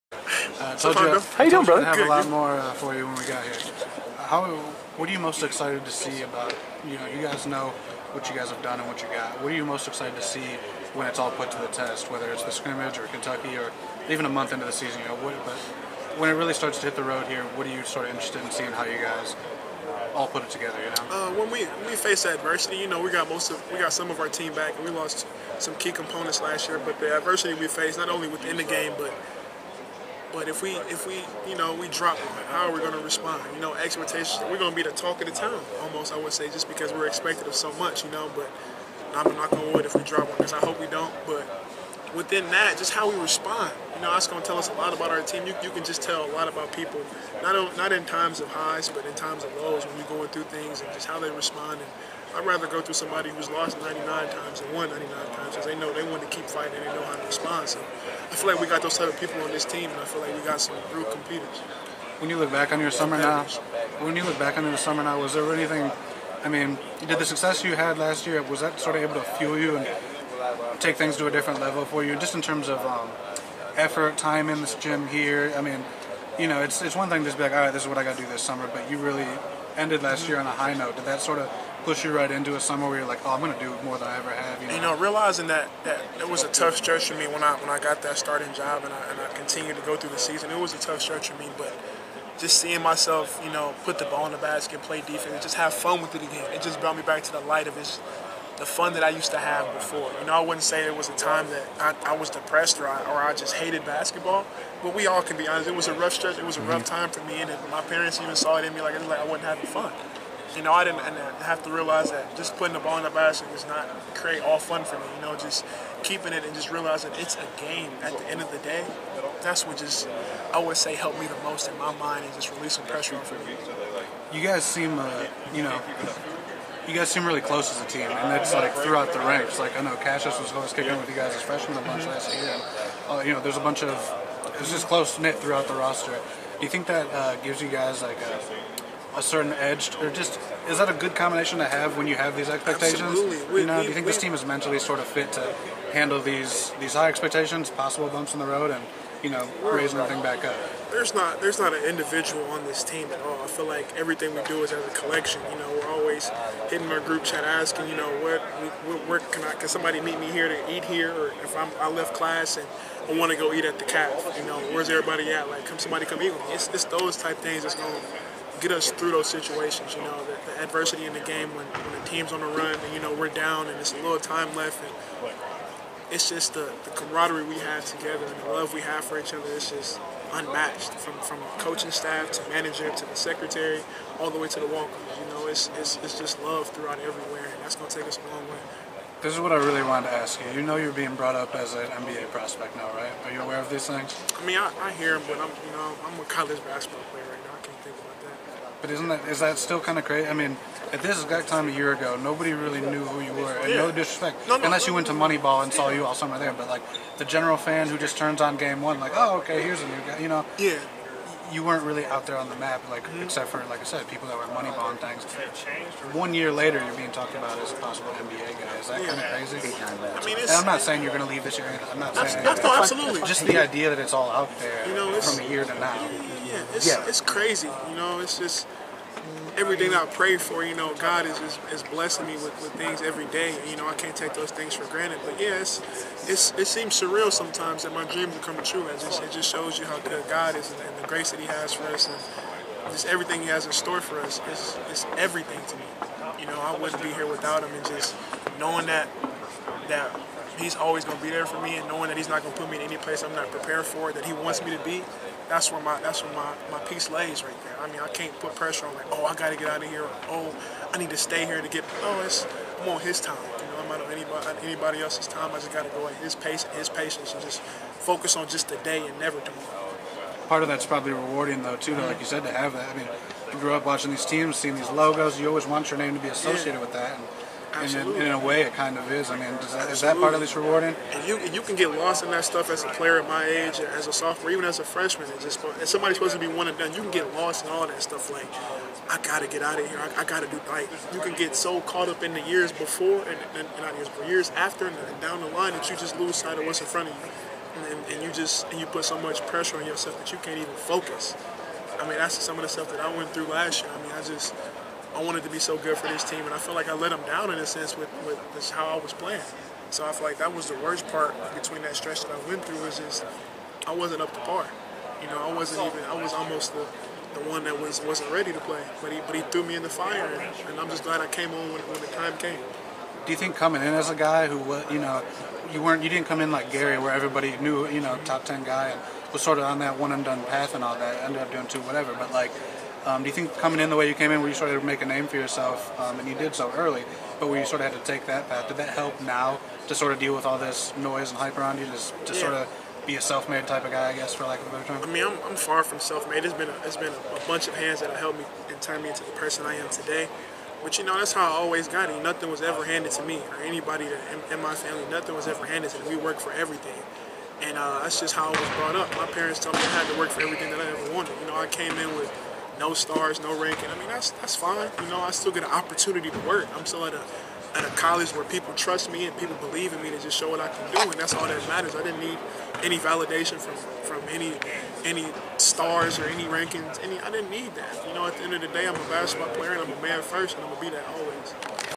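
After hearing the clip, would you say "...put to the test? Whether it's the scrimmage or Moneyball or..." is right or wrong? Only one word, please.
wrong.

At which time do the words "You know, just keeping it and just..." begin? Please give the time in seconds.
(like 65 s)
115 s.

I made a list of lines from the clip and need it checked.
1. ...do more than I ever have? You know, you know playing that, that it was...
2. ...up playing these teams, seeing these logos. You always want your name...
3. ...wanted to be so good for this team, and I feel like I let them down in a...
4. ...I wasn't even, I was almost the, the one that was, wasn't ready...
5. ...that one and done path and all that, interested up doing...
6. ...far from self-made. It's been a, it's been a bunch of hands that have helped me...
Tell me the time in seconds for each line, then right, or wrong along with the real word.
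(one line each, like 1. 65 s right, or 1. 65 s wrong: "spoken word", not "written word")
1. 83 s wrong: "realizing", not "playing"
2. 273 s wrong: "watching", not "playing"
3. 305 s right
4. 315 s right
5. 329 s wrong: "ended", not "interested"
6. 345 s right.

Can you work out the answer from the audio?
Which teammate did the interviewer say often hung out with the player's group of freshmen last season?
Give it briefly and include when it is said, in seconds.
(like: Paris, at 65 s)
Cassius, at 129 s.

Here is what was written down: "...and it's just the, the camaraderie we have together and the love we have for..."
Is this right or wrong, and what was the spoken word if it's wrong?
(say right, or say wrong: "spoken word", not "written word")
right.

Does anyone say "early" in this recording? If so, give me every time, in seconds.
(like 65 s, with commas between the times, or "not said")
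336 s.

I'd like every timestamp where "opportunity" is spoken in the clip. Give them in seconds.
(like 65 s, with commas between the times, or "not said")
365 s.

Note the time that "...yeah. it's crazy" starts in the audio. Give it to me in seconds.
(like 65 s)
226 s.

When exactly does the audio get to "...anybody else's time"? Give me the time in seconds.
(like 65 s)
264 s.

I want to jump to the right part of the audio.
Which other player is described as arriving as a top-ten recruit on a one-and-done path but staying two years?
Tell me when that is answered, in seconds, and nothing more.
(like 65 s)
326 s.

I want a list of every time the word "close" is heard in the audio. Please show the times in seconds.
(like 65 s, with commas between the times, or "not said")
127 s, 134 s.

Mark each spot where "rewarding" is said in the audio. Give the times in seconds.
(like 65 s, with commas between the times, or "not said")
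271 s, 280 s.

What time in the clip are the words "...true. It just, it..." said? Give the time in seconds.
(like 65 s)
238 s.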